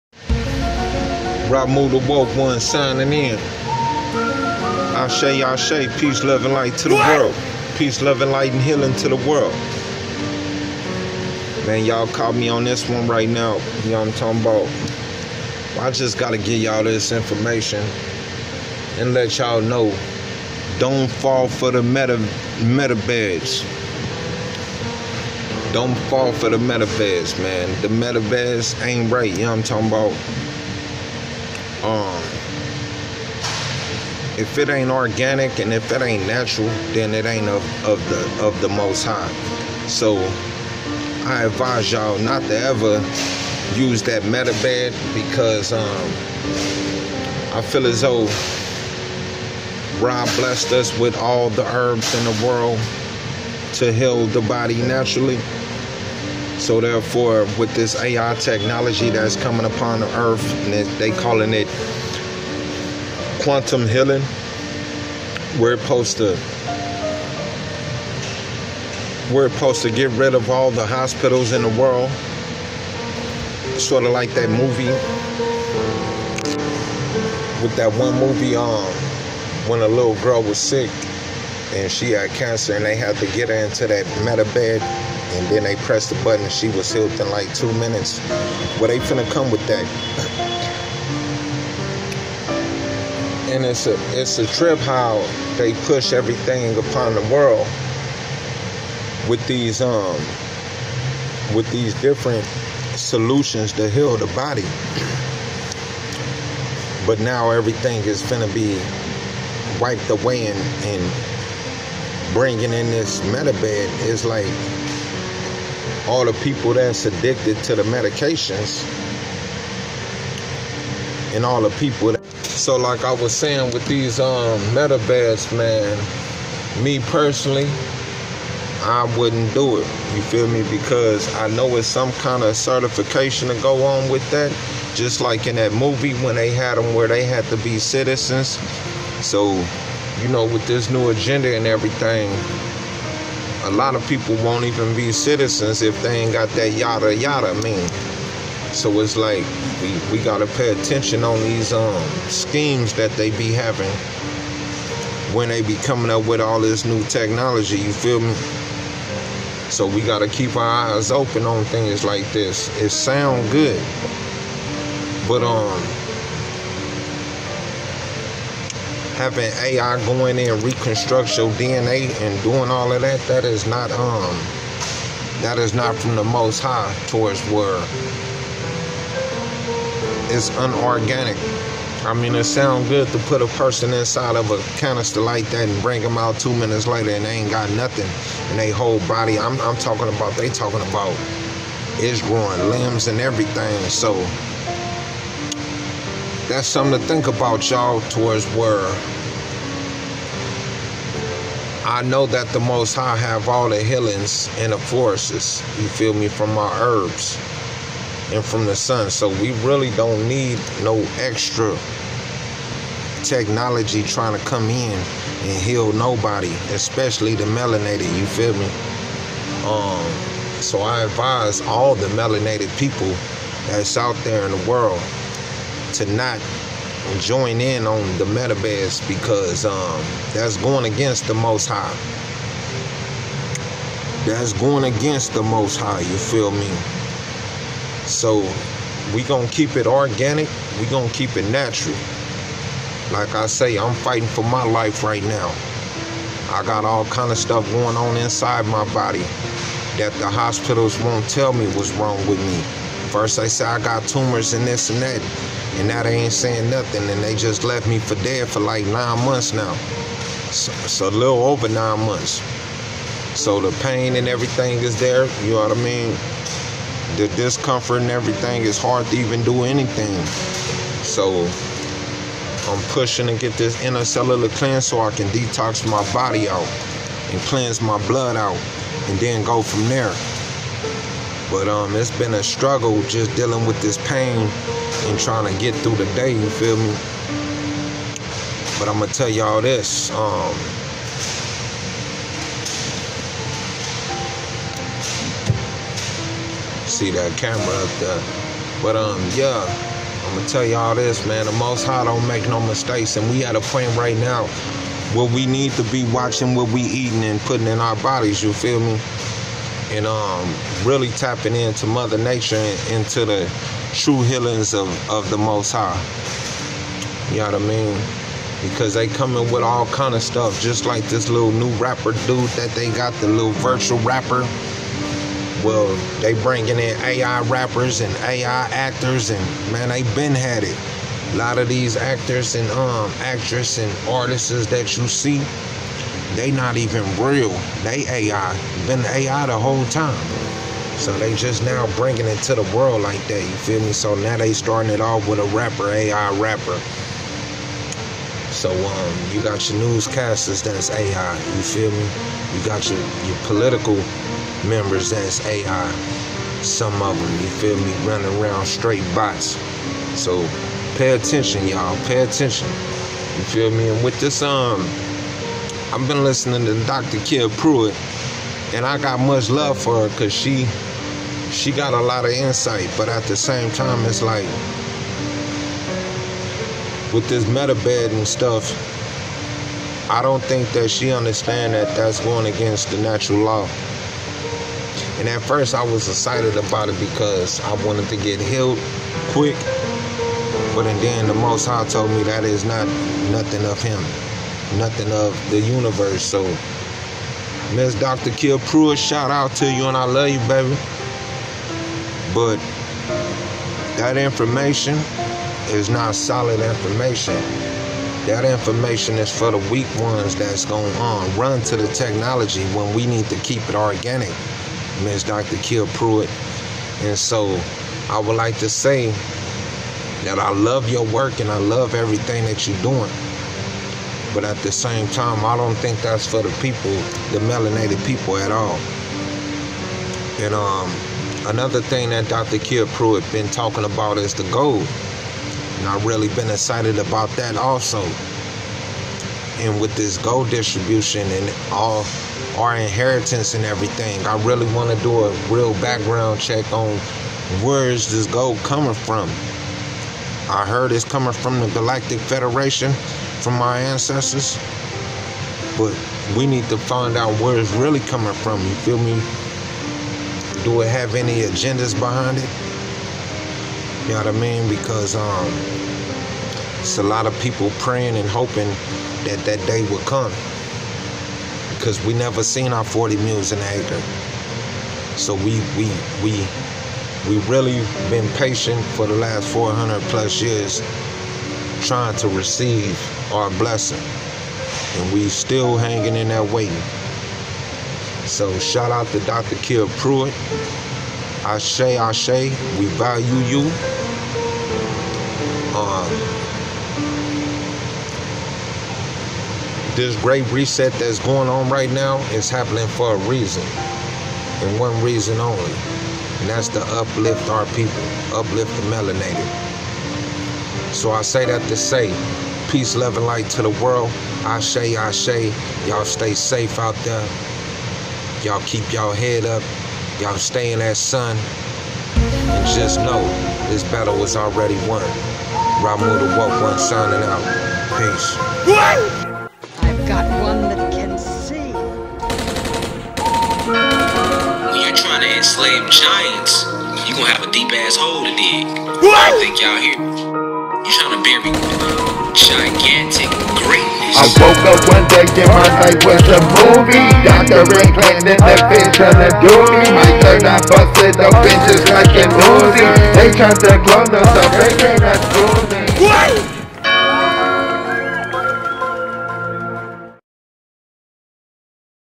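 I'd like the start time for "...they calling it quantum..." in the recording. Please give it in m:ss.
1:00.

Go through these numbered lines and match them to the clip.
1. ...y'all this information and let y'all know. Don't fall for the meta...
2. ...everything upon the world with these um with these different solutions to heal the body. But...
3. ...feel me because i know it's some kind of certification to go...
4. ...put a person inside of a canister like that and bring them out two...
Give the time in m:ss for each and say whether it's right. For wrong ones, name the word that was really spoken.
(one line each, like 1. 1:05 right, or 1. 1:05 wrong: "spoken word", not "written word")
1. 0:16 right
2. 1:36 right
3. 2:10 right
4. 3:03 right.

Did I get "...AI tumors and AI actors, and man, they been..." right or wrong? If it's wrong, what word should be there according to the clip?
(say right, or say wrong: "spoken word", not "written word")
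wrong: "rappers", not "tumors".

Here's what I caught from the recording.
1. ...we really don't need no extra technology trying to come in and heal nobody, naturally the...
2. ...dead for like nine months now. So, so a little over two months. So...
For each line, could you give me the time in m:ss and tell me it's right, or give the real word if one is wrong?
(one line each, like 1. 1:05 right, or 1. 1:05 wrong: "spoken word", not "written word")
1. 3:29 wrong: "especially", not "naturally"
2. 4:18 wrong: "nine", not "two".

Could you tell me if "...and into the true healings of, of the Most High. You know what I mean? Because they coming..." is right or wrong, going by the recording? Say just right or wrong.
right.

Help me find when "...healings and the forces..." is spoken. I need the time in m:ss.
3:23.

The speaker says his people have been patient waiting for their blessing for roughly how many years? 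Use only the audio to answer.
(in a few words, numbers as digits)
400 plus years.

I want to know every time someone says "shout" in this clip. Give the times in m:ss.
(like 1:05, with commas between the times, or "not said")
6:38, 8:08.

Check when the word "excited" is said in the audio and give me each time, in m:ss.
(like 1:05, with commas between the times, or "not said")
6:26, 7:16.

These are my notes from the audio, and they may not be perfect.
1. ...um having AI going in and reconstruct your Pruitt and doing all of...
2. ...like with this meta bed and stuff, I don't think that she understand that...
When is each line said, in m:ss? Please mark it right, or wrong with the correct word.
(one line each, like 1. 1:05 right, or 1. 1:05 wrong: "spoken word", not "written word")
1. 2:45 wrong: "DNA", not "Pruitt"
2. 6:14 right.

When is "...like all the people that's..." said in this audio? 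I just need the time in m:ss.
1:54.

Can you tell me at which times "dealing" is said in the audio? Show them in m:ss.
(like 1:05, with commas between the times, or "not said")
4:43.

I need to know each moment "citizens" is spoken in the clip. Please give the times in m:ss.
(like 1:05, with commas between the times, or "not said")
2:17, 2:25.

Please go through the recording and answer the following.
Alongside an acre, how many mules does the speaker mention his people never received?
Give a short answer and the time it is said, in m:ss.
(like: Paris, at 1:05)
40, at 7:52.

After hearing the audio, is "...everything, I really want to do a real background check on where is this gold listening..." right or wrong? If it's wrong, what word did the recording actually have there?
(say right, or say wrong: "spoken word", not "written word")
wrong: "coming", not "listening".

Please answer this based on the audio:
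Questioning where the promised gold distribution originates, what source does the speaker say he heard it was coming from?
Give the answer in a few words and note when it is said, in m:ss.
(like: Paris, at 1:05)
Galactic Federation, at 7:31.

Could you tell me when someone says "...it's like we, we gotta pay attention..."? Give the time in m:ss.
2:29.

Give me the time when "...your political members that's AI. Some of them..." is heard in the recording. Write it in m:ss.
5:53.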